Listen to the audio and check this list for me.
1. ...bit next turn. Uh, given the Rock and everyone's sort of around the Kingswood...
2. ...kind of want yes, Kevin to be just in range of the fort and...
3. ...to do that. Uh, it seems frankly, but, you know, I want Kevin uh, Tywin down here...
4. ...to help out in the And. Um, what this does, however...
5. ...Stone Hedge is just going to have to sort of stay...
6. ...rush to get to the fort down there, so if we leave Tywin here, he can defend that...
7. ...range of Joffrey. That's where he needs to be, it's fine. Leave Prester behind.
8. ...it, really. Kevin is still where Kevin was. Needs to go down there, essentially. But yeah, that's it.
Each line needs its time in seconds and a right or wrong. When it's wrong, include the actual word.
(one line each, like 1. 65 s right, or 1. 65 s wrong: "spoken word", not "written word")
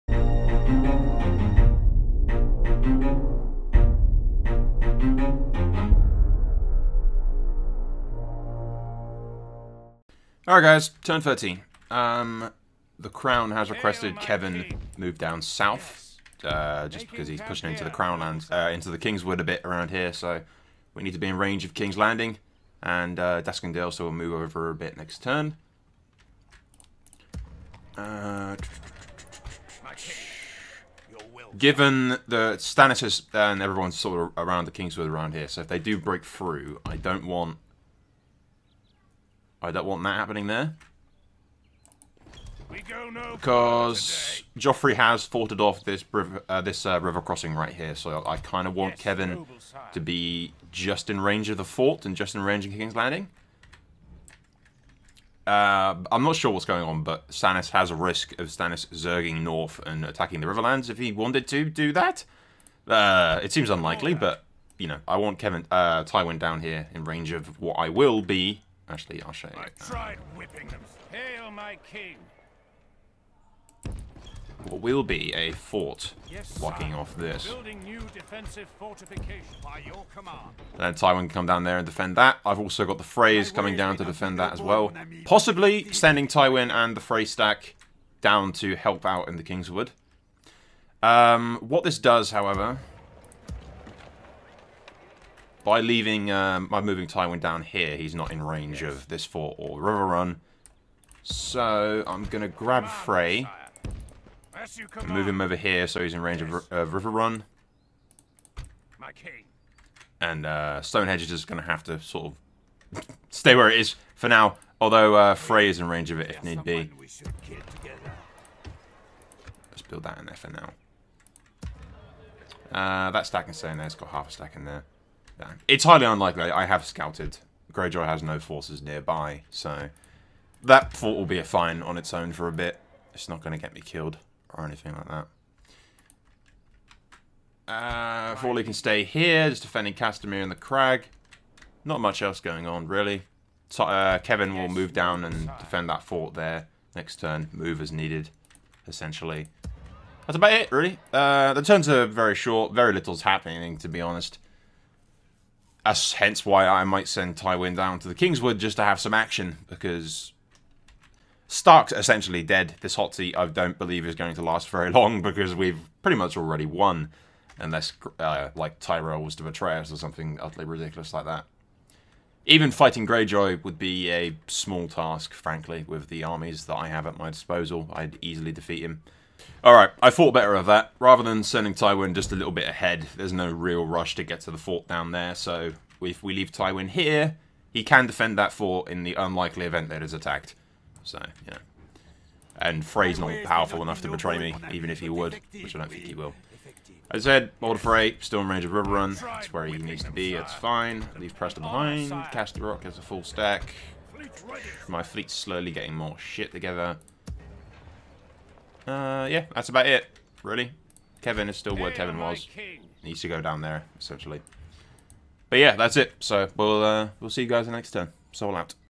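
1. 24 s wrong: "Stannis", not "Rock"
2. 48 s right
3. 61 s wrong: "unlikely", not "frankly"
4. 88 s wrong: "Kingswood", not "And"
5. 110 s right
6. 183 s right
7. 198 s wrong: "Riverrun", not "Joffrey"
8. 209 s right.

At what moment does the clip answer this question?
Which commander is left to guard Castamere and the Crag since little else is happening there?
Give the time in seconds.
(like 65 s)
138 s.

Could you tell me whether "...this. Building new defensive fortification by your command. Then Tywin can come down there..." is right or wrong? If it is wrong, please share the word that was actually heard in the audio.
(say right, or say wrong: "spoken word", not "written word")
right.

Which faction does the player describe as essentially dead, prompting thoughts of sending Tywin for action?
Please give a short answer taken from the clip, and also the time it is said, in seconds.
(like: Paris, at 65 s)
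Stark, at 161 s.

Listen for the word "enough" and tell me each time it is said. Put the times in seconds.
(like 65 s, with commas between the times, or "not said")
193 s.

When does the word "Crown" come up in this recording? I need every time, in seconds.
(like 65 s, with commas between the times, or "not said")
13 s, 17 s.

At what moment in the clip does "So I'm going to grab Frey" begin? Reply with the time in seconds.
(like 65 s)
101 s.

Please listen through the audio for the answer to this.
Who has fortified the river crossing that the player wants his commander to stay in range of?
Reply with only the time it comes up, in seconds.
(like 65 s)
44 s.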